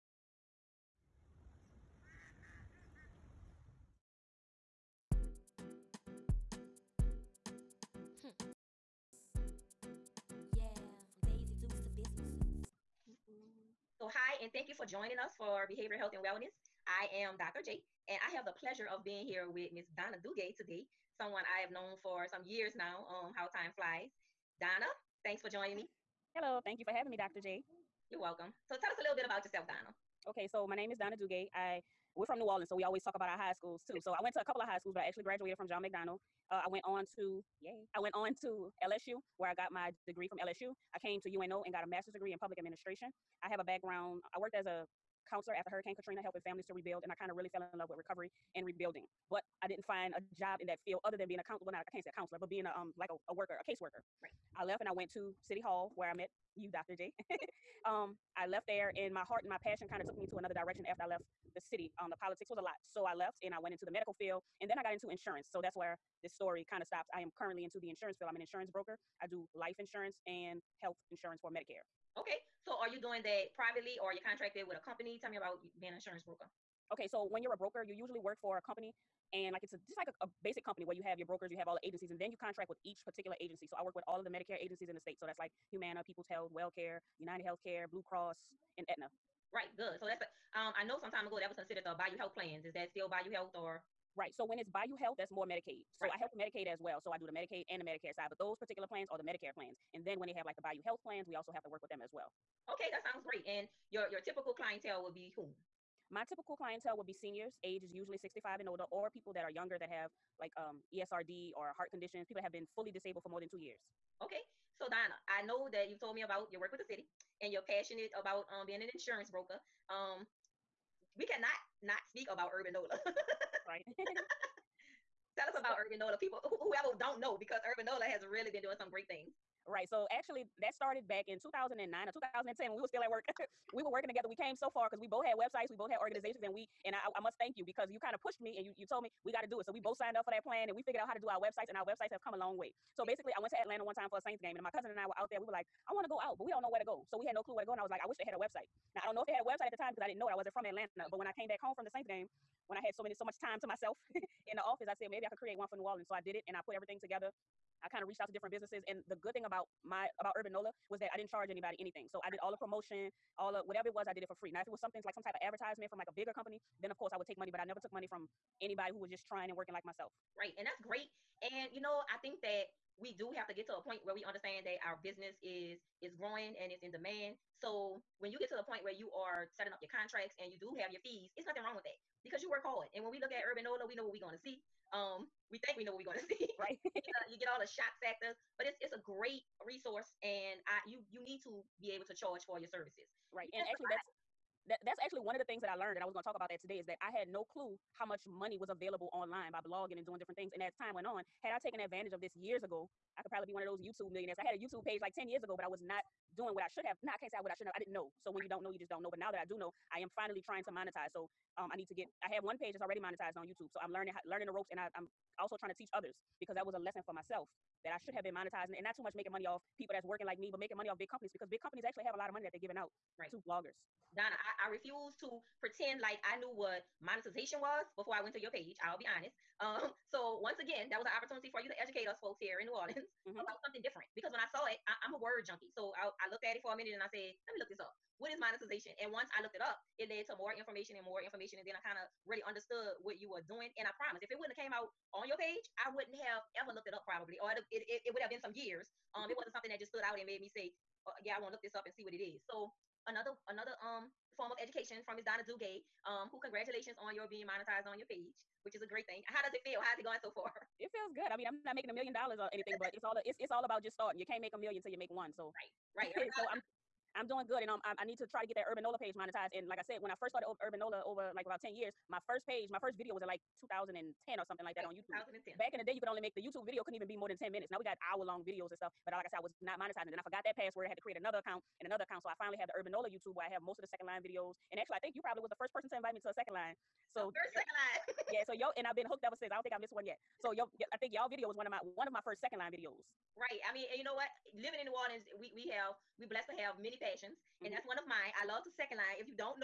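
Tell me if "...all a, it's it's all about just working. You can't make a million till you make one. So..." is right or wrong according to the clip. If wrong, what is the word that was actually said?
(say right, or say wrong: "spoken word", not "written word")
wrong: "starting", not "working".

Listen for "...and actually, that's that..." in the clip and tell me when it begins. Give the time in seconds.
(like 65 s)
193 s.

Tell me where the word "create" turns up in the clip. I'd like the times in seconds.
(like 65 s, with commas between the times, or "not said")
155 s, 281 s.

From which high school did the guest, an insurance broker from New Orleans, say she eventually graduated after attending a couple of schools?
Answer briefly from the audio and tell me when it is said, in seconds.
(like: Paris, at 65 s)
John McDonogh, at 35 s.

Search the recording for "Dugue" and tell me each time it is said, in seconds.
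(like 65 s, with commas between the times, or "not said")
20 s, 31 s, 255 s.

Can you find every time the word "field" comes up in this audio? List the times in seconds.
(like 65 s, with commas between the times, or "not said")
50 s, 64 s, 68 s.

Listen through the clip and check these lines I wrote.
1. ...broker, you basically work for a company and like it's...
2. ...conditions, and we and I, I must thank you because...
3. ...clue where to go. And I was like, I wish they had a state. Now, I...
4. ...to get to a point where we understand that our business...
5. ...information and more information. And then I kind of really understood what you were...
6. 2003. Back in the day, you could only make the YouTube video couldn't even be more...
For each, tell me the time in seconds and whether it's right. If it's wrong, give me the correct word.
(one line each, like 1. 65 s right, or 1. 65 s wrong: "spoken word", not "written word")
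1. 77 s wrong: "usually", not "basically"
2. 135 s wrong: "organizations", not "conditions"
3. 147 s wrong: "website", not "state"
4. 173 s right
5. 240 s right
6. 275 s wrong: "2010", not "2003".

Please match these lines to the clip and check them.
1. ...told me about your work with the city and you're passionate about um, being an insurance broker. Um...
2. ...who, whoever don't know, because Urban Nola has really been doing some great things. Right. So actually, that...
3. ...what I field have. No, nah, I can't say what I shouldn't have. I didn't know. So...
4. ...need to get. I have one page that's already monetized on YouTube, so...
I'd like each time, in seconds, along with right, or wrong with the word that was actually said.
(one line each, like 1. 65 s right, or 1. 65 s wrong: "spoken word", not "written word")
1. 116 s right
2. 126 s right
3. 206 s wrong: "should", not "field"
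4. 211 s right.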